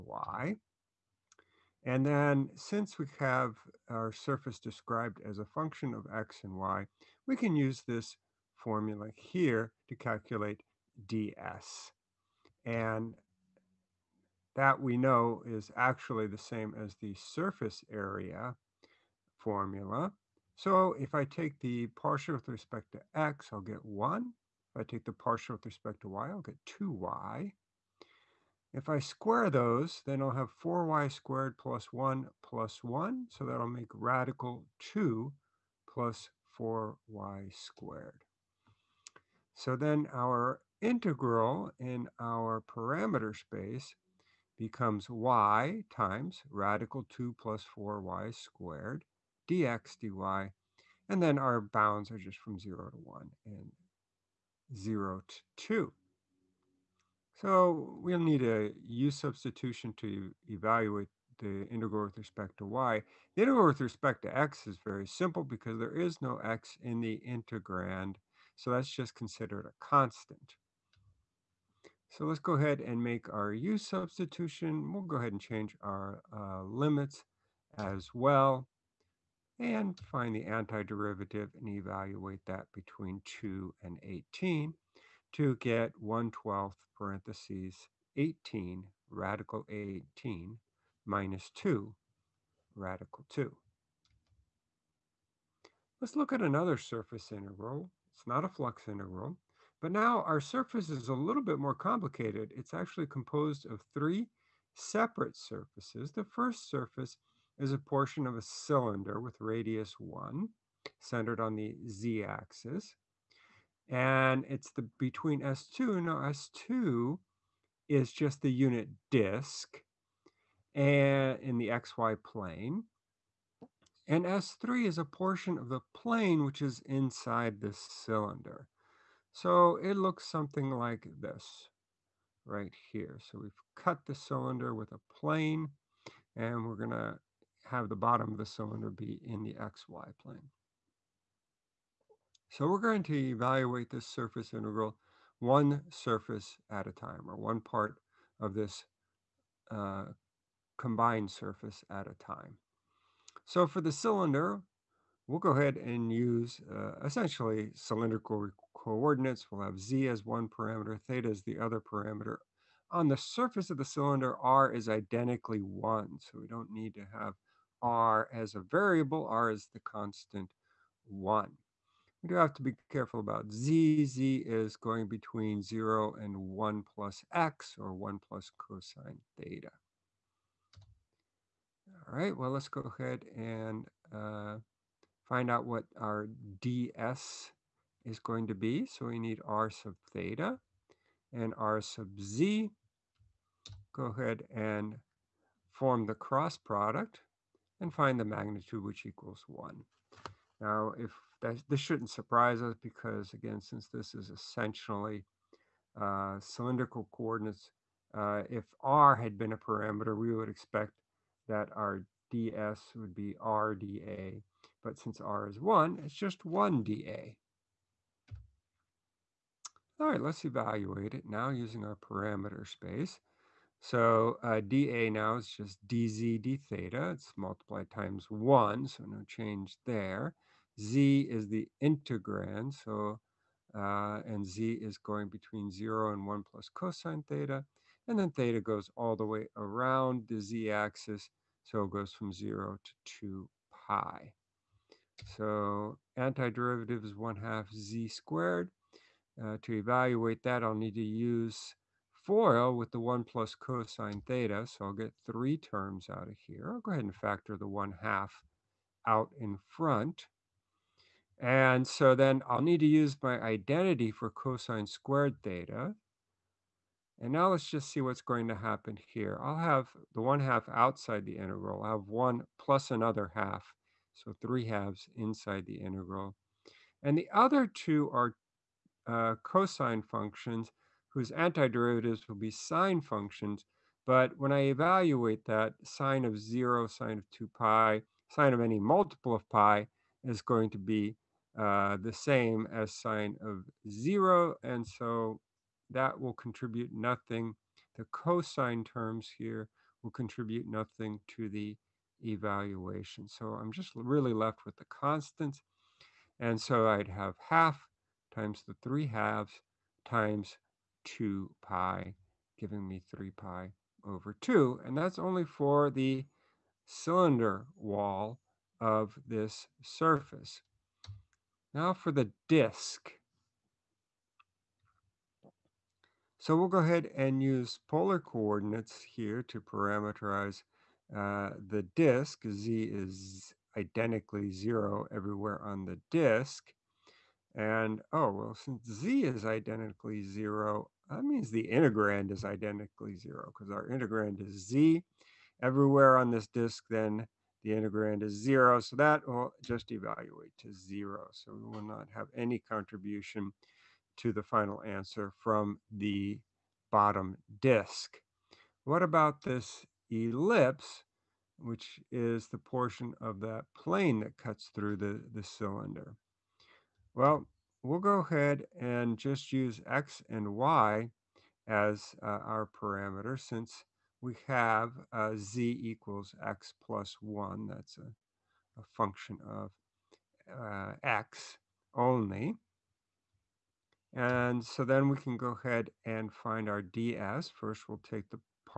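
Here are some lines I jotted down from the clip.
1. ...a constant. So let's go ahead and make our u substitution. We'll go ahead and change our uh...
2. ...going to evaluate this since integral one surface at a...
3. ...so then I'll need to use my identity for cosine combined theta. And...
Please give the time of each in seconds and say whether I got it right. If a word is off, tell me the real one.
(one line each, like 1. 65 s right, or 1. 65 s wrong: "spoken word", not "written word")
1. 69 s right
2. 142 s wrong: "surface", not "since"
3. 261 s wrong: "squared", not "combined".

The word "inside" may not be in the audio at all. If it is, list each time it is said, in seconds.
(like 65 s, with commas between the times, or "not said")
126 s, 275 s.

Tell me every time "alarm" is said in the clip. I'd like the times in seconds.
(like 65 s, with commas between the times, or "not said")
not said.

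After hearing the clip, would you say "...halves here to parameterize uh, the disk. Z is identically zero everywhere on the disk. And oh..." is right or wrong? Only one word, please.
wrong.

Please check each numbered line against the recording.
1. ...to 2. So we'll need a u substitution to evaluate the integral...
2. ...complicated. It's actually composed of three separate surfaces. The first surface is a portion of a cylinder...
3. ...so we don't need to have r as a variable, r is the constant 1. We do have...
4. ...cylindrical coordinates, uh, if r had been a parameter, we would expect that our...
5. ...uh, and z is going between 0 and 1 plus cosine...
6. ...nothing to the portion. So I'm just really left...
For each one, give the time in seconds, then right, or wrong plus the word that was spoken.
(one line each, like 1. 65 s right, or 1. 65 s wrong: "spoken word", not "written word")
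1. 55 s right
2. 101 s right
3. 166 s right
4. 206 s right
5. 233 s right
6. 300 s wrong: "evaluation", not "portion".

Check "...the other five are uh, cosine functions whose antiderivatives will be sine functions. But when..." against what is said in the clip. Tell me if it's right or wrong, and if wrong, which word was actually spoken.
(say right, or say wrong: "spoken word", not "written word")
wrong: "two", not "five".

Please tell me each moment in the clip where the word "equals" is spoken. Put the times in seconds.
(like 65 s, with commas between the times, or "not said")
199 s, 375 s.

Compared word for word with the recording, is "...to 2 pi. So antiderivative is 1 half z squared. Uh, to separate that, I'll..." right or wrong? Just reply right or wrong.
wrong.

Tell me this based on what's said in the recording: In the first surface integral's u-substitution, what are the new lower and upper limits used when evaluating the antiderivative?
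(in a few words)
2 and 18.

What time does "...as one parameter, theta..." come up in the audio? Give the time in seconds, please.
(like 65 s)
160 s.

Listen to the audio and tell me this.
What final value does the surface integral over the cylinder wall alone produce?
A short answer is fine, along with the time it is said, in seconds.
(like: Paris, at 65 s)
3 pi over 2, at 313 s.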